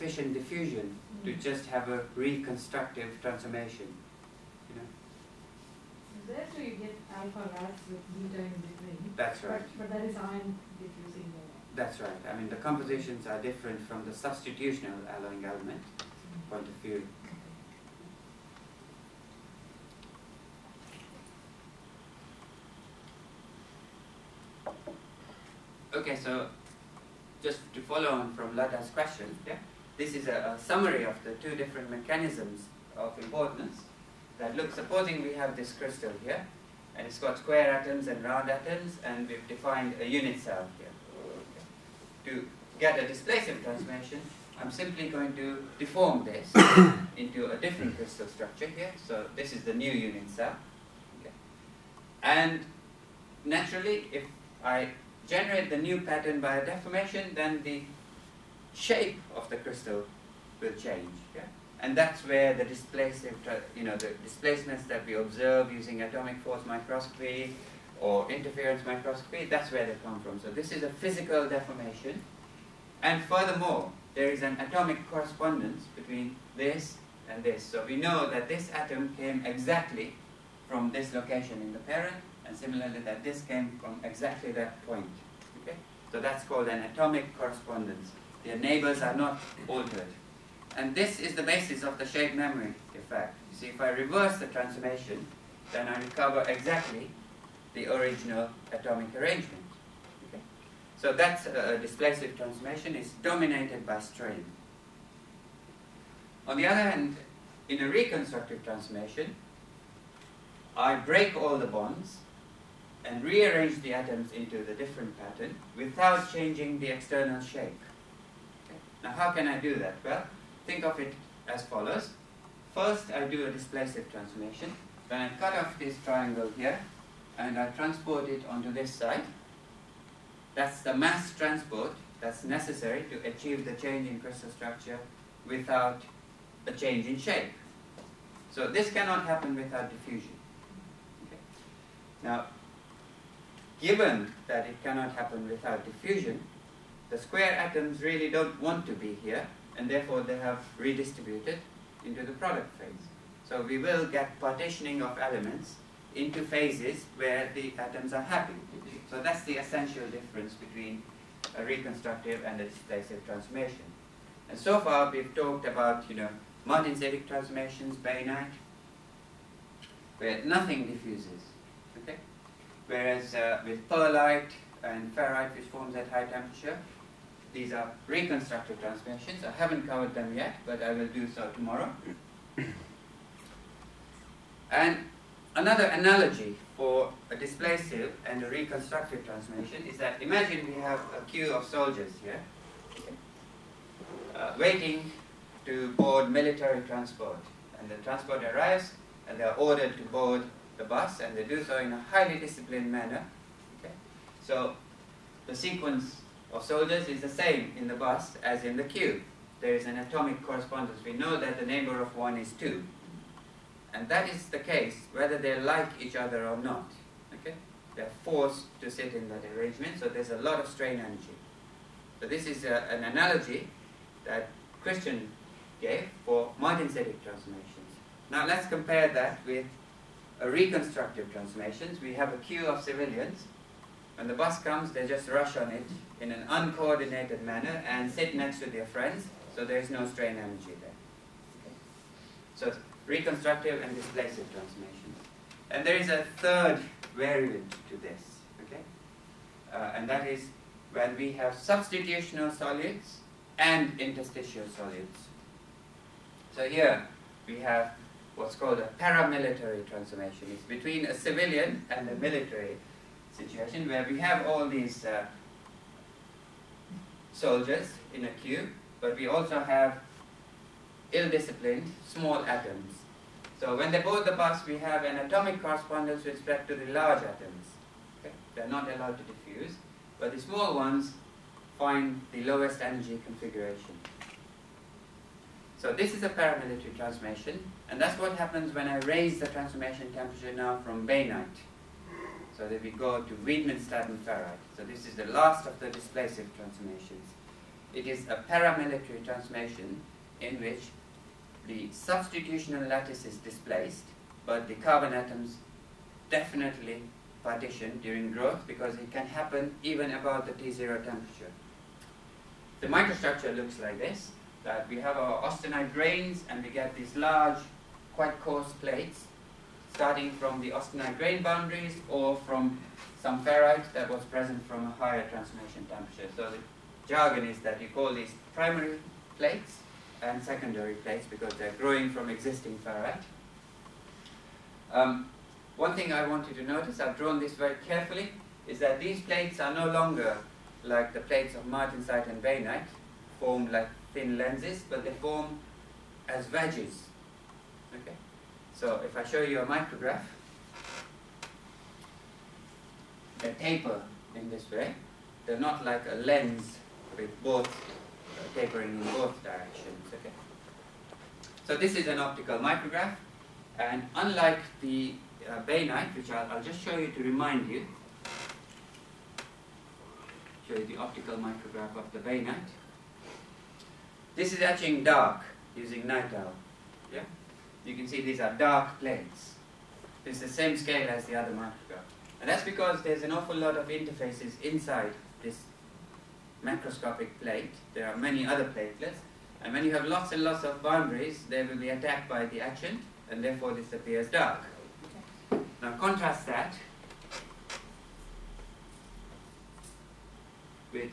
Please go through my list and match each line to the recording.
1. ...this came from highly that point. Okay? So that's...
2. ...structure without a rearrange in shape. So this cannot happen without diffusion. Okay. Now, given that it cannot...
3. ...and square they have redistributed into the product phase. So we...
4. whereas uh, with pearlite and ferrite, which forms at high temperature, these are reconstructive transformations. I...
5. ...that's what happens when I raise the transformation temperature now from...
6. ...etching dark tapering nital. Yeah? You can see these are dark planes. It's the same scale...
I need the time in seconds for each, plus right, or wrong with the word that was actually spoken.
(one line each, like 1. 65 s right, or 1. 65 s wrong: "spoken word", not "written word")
1. 83 s wrong: "exactly", not "highly"
2. 134 s wrong: "change", not "rearrange"
3. 149 s wrong: "therefore", not "square"
4. 172 s right
5. 288 s right
6. 374 s wrong: "using", not "tapering".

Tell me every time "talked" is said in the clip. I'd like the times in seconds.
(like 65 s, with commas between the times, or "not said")
165 s.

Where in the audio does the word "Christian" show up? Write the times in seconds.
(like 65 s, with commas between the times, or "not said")
224 s.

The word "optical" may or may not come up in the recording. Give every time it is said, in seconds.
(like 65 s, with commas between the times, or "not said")
362 s, 370 s.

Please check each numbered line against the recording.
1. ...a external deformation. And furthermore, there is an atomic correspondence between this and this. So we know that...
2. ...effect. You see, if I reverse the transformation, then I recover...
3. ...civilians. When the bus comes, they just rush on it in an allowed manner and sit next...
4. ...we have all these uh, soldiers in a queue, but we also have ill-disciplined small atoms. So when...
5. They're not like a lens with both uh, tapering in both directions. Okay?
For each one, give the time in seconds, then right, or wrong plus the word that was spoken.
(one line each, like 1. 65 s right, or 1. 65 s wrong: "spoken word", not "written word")
1. 70 s wrong: "physical", not "external"
2. 92 s right
3. 232 s wrong: "uncoordinated", not "allowed"
4. 264 s right
5. 355 s right.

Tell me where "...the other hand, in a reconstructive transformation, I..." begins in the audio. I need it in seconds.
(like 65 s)
106 s.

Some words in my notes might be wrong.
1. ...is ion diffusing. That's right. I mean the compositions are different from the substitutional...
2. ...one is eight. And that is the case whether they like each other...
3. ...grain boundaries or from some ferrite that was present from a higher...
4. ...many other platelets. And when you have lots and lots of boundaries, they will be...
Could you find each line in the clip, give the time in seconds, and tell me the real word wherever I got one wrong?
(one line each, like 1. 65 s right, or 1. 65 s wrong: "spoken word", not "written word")
1. 10 s right
2. 212 s wrong: "two", not "eight"
3. 321 s right
4. 388 s right.